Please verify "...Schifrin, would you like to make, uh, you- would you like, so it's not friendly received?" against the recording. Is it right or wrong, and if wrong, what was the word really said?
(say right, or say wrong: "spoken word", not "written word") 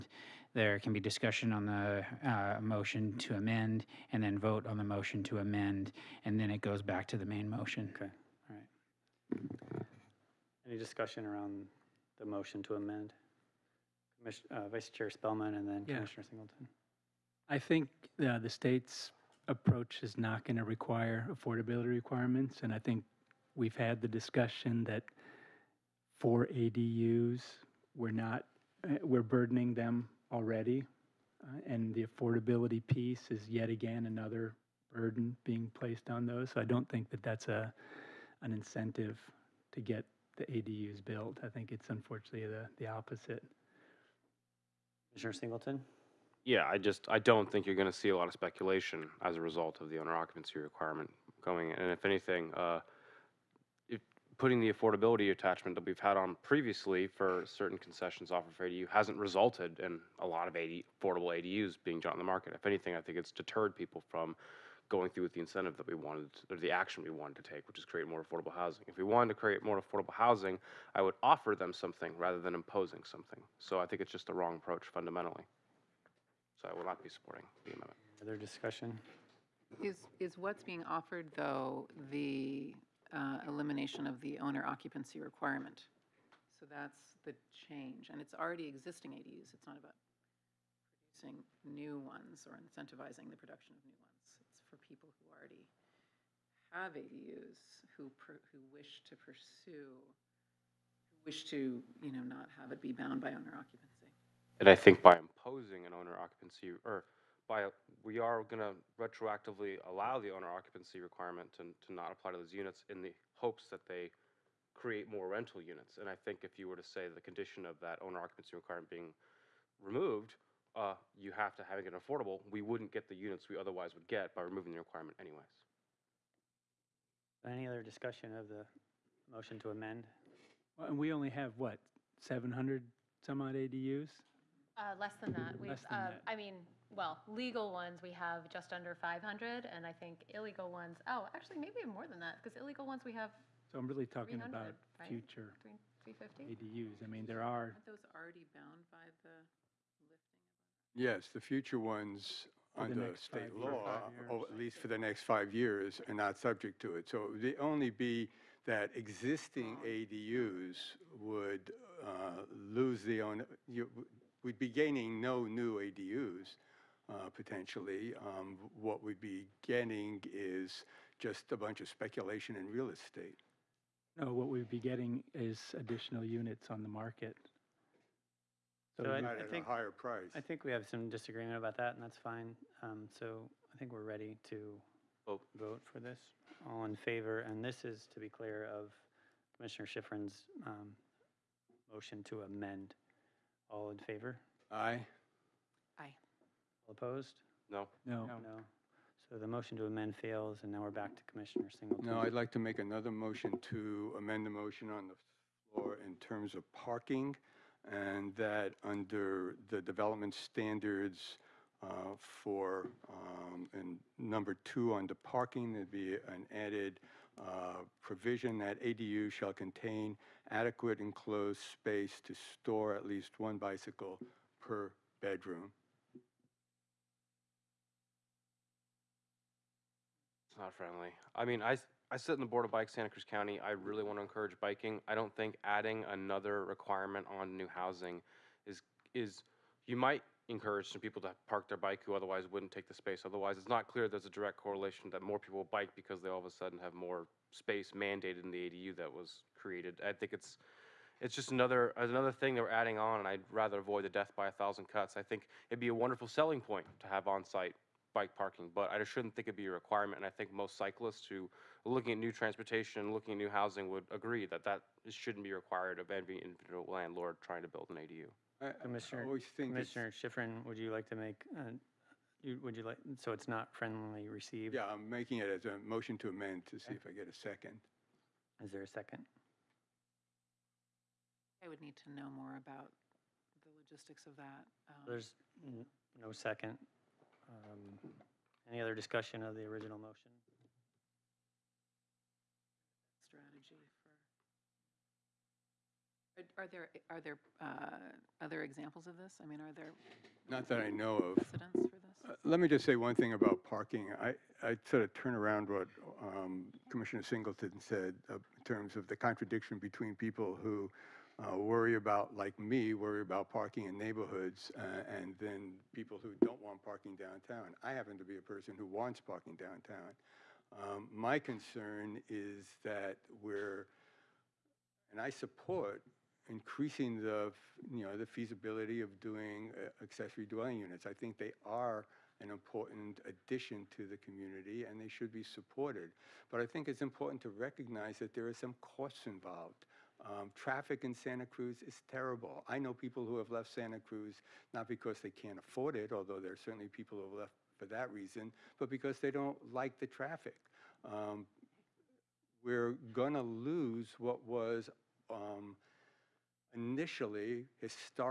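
right.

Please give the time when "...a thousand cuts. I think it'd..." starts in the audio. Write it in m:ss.
4:14.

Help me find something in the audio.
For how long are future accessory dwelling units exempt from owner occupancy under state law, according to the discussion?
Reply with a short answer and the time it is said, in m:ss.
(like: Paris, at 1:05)
5 years, at 2:35.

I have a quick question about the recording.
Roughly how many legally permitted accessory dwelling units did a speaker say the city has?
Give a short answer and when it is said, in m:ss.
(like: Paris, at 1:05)
just under 500, at 2:18.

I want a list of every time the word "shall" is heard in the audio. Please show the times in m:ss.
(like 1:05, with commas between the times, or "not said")
3:39.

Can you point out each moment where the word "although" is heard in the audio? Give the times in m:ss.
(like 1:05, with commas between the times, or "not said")
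5:46.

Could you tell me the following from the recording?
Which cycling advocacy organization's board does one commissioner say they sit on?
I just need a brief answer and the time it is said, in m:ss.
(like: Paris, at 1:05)
Bike Santa Cruz County, at 3:52.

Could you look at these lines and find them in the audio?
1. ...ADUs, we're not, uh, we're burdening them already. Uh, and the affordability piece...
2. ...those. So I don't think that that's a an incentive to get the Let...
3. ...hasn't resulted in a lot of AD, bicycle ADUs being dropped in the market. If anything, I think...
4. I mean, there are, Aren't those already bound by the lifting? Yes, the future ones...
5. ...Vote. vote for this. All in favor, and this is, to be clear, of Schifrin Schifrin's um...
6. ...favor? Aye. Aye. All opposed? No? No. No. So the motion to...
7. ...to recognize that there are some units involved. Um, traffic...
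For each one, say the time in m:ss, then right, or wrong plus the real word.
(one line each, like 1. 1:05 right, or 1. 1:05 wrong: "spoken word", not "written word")
1. 0:26 right
2. 0:36 wrong: "ADUs", not "Let"
3. 0:58 wrong: "affordable", not "bicycle"
4. 2:27 right
5. 3:05 wrong: "Commissioner", not "Schifrin"
6. 3:13 right
7. 5:37 wrong: "costs", not "units".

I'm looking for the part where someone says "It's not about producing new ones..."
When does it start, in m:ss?
1:29.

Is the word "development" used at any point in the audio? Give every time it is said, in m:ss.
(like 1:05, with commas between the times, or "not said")
3:29.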